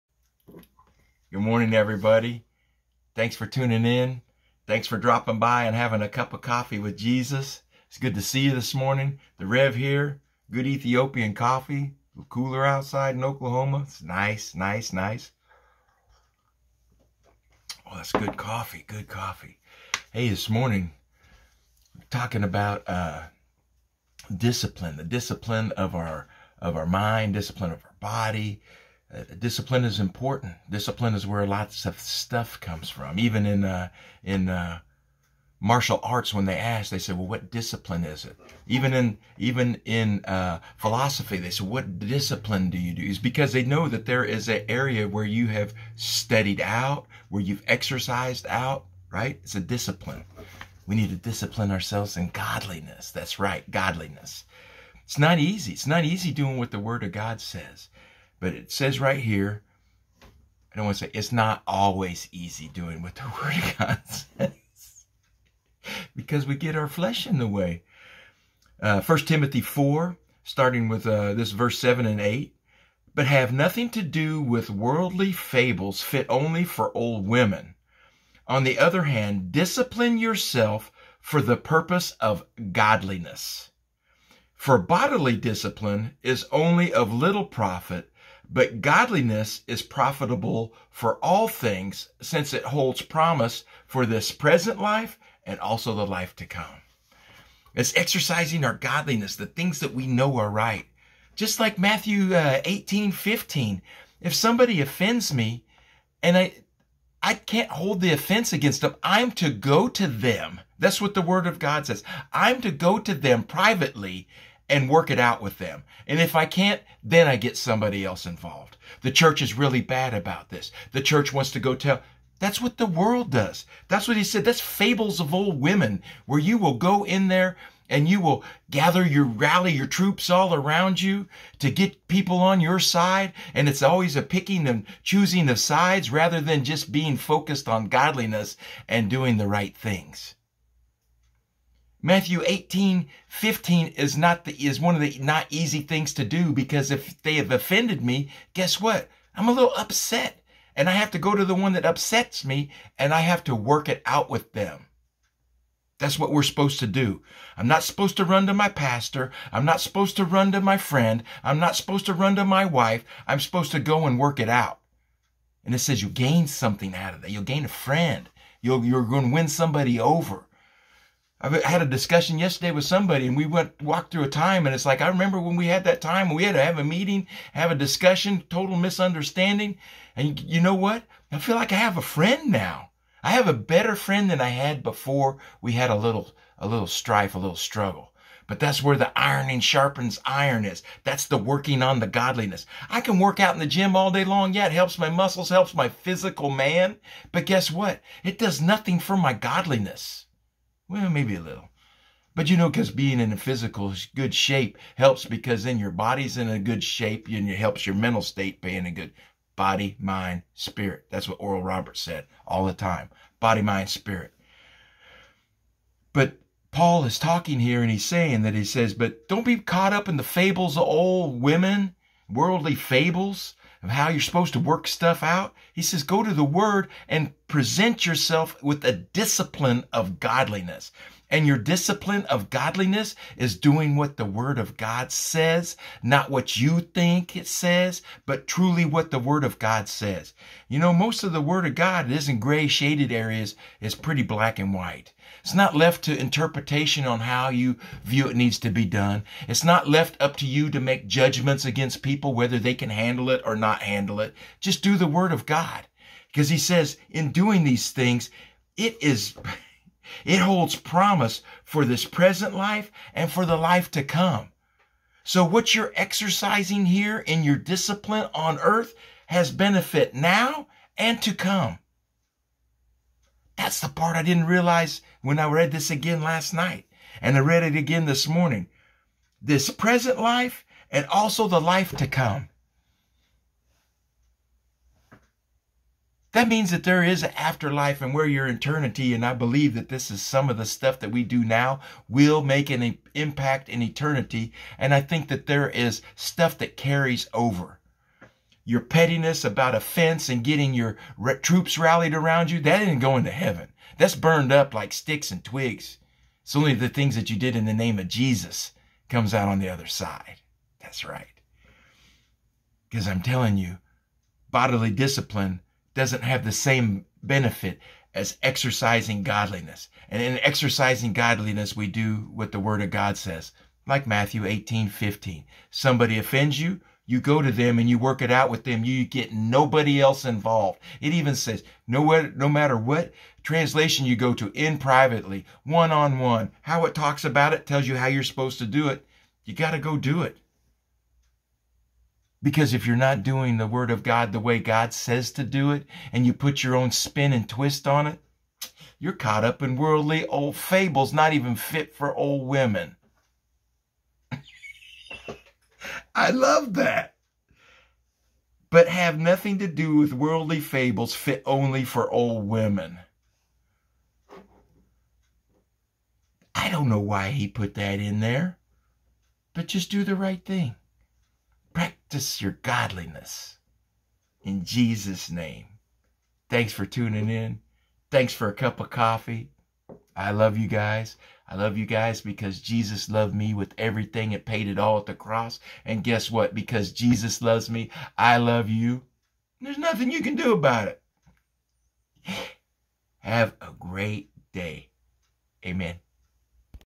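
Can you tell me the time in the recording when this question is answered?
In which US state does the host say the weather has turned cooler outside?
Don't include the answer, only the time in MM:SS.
00:13.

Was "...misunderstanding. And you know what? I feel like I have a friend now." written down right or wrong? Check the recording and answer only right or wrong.
right.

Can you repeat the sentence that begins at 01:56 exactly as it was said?
And if I can't, then I get somebody else involved.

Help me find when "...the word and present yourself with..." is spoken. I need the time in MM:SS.
03:46.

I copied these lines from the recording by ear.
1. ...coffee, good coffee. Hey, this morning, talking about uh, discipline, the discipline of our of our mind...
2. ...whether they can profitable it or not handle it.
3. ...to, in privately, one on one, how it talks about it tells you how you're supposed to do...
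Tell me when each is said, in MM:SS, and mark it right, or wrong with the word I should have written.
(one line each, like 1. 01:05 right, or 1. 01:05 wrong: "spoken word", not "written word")
1. 00:18 right
2. 04:12 wrong: "handle", not "profitable"
3. 05:34 right.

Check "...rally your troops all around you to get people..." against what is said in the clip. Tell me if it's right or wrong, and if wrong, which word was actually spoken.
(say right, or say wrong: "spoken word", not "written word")
right.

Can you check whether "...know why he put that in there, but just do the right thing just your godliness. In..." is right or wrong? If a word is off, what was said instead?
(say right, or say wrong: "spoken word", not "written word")
right.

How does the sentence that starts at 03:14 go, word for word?
Yeah, it helps my muscles, helps my physical man.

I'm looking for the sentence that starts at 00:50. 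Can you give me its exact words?
We need to discipline ourselves in godliness.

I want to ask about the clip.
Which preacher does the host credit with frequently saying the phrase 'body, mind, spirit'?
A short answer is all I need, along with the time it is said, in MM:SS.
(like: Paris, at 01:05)
Oral Roberts, at 03:31.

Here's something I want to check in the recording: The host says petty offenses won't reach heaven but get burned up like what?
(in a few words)
sticks and twigs.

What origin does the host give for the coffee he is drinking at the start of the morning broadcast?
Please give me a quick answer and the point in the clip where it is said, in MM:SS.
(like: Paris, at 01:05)
Ethiopian, at 00:10.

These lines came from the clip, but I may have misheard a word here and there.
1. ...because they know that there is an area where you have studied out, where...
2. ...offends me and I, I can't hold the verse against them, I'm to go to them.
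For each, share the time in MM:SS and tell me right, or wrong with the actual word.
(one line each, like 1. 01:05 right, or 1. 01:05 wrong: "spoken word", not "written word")
1. 00:43 right
2. 01:44 wrong: "offense", not "verse".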